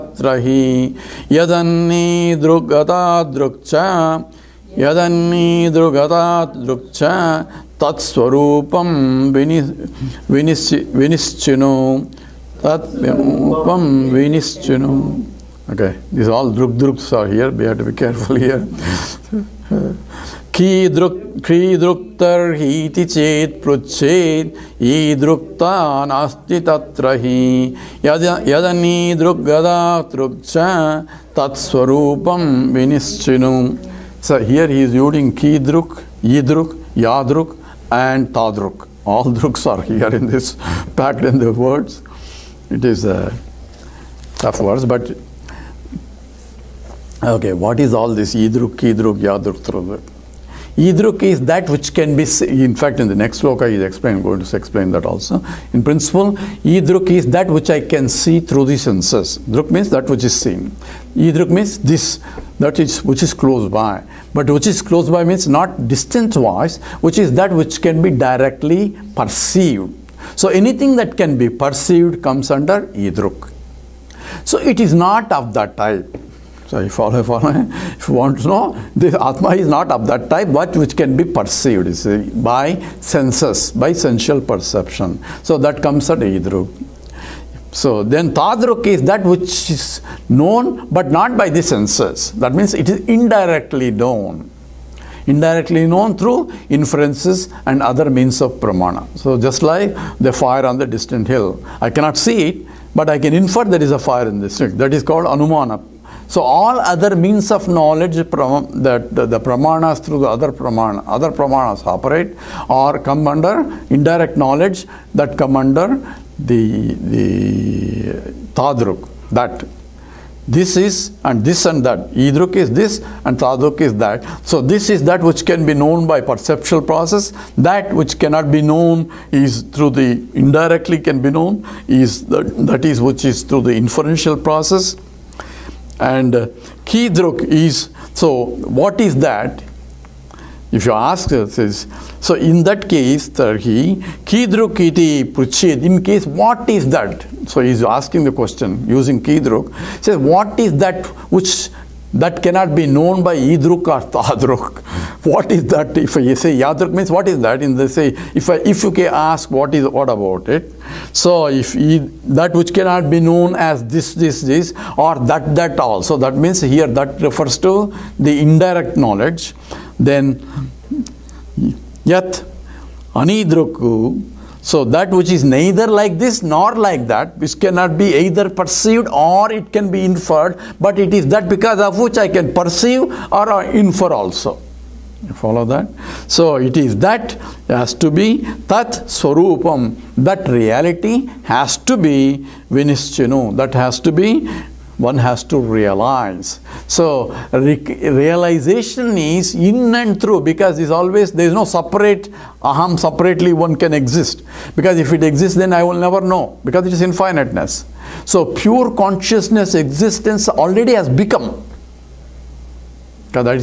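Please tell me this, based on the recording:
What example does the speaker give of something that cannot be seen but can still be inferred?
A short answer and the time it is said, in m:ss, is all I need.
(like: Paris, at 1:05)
Fire on the distant hill, at 1:40.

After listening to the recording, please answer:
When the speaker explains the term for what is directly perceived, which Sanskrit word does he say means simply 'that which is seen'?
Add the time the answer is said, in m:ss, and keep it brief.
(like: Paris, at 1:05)
Druk, at 0:59.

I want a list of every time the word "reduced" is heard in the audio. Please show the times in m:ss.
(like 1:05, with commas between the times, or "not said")
not said.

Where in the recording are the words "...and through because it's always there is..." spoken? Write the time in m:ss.
3:19.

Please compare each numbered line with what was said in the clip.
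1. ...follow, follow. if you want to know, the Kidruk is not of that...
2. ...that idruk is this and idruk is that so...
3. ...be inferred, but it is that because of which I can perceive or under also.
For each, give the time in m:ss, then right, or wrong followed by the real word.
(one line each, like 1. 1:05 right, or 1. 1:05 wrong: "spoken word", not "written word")
1. 1:16 wrong: "Atma", not "Kidruk"
2. 2:01 wrong: "tadruk", not "idruk"
3. 2:59 wrong: "infer", not "under".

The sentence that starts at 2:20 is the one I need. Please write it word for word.
If you ask this, so in that case, Tarhi, Kidruk iti pruchid, in case what is that?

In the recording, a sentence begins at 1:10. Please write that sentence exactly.
So anything that can be perceived comes under Idruk.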